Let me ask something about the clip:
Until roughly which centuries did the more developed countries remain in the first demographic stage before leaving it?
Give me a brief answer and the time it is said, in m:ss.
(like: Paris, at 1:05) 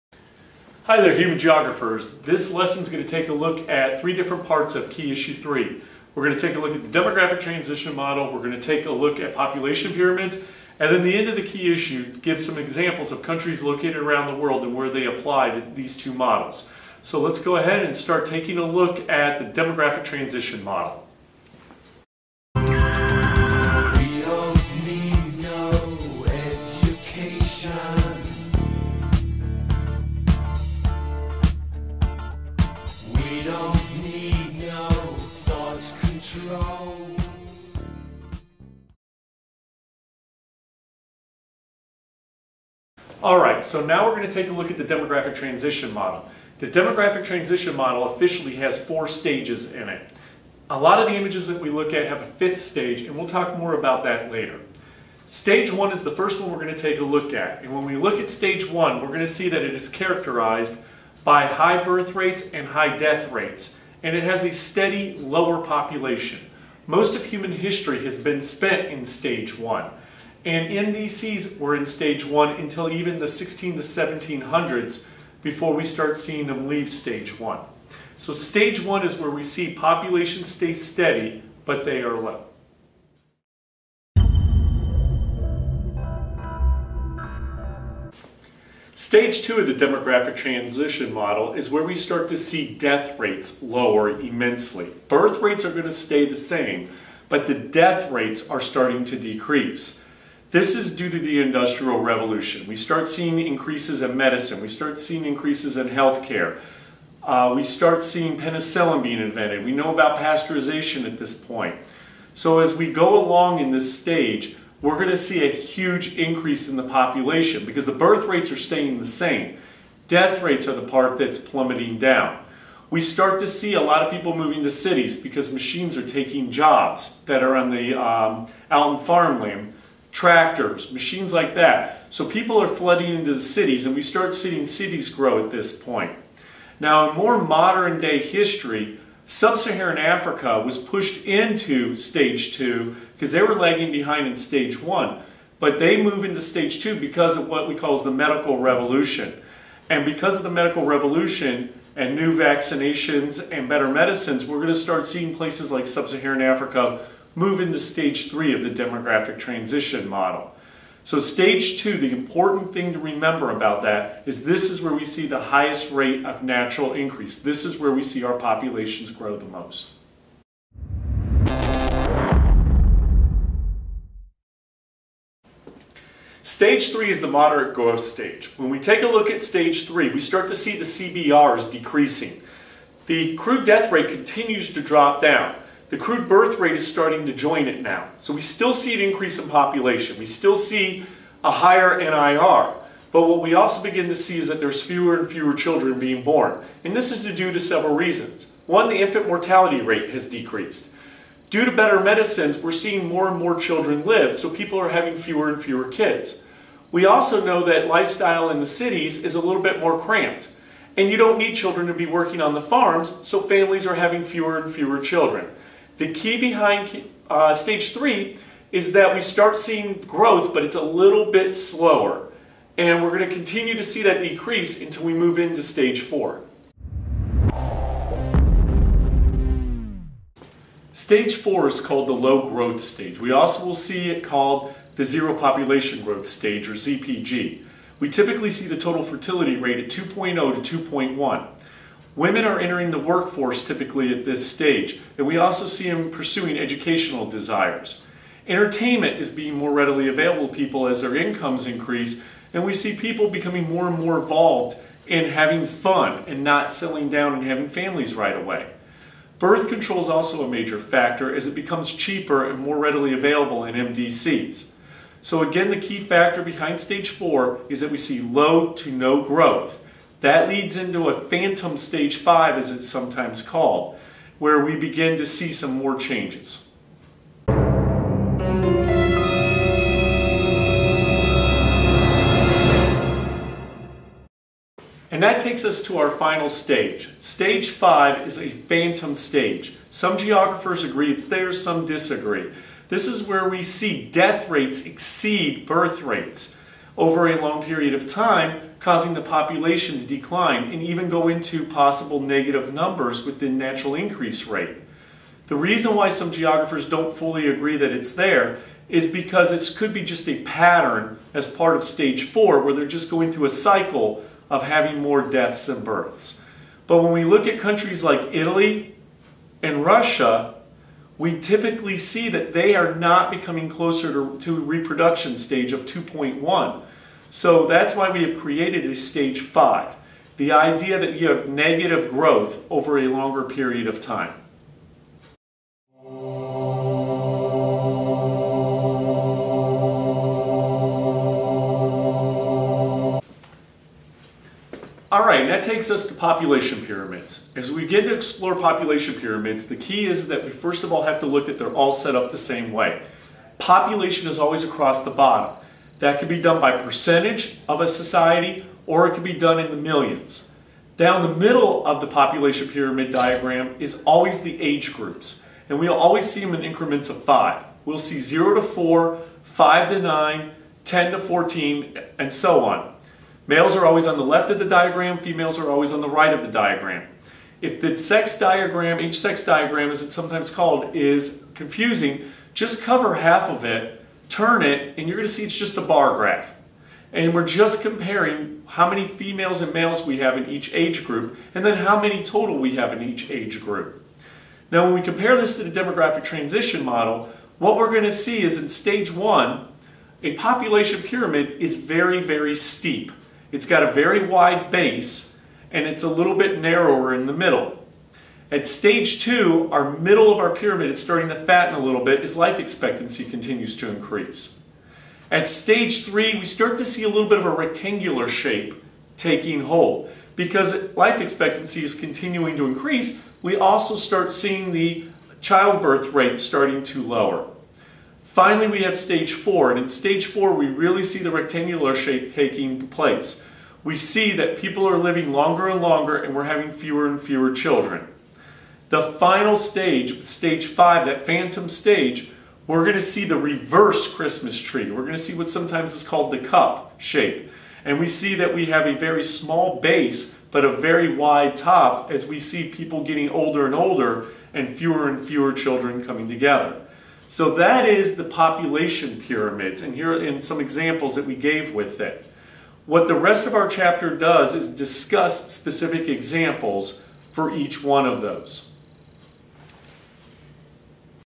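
1600s to 1700s, at 1:13.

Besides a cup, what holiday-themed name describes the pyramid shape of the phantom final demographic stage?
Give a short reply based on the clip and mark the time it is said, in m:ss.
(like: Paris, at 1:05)
reverse Christmas tree, at 7:23.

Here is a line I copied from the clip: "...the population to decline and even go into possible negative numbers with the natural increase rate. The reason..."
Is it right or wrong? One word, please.
right.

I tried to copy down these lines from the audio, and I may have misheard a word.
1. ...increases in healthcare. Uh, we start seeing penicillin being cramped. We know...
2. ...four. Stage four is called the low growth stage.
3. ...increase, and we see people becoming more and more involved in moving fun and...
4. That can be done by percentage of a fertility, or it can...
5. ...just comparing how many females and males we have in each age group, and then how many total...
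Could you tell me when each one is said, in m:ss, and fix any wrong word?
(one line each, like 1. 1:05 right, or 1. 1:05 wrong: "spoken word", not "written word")
1. 1:45 wrong: "invented", not "cramped"
2. 3:46 right
3. 4:11 wrong: "having", not "moving"
4. 5:55 wrong: "society", not "fertility"
5. 6:27 right.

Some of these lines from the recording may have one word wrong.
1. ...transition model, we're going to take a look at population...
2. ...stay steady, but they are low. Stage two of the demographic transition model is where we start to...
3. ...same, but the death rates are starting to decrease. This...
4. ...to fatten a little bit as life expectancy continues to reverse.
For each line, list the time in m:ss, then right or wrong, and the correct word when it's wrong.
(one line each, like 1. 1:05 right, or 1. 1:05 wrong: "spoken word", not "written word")
1. 0:07 right
2. 1:20 right
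3. 1:36 right
4. 6:51 wrong: "increase", not "reverse".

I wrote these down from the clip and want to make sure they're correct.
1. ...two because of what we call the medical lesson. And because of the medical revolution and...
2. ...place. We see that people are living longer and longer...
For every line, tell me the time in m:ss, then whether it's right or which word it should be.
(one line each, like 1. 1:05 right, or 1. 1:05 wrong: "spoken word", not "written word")
1. 2:26 wrong: "revolution", not "lesson"
2. 7:12 right.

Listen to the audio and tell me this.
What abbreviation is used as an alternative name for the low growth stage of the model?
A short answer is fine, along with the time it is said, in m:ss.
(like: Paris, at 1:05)
ZPG, at 3:56.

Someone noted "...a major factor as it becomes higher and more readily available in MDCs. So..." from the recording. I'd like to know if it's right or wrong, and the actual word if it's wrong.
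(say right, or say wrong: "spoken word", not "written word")
wrong: "cheaper", not "higher".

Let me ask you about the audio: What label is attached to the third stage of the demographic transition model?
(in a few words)
moderate growth stage.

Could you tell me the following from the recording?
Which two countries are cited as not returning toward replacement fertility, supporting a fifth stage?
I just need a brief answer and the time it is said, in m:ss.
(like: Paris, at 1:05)
Italy and Russia, at 5:18.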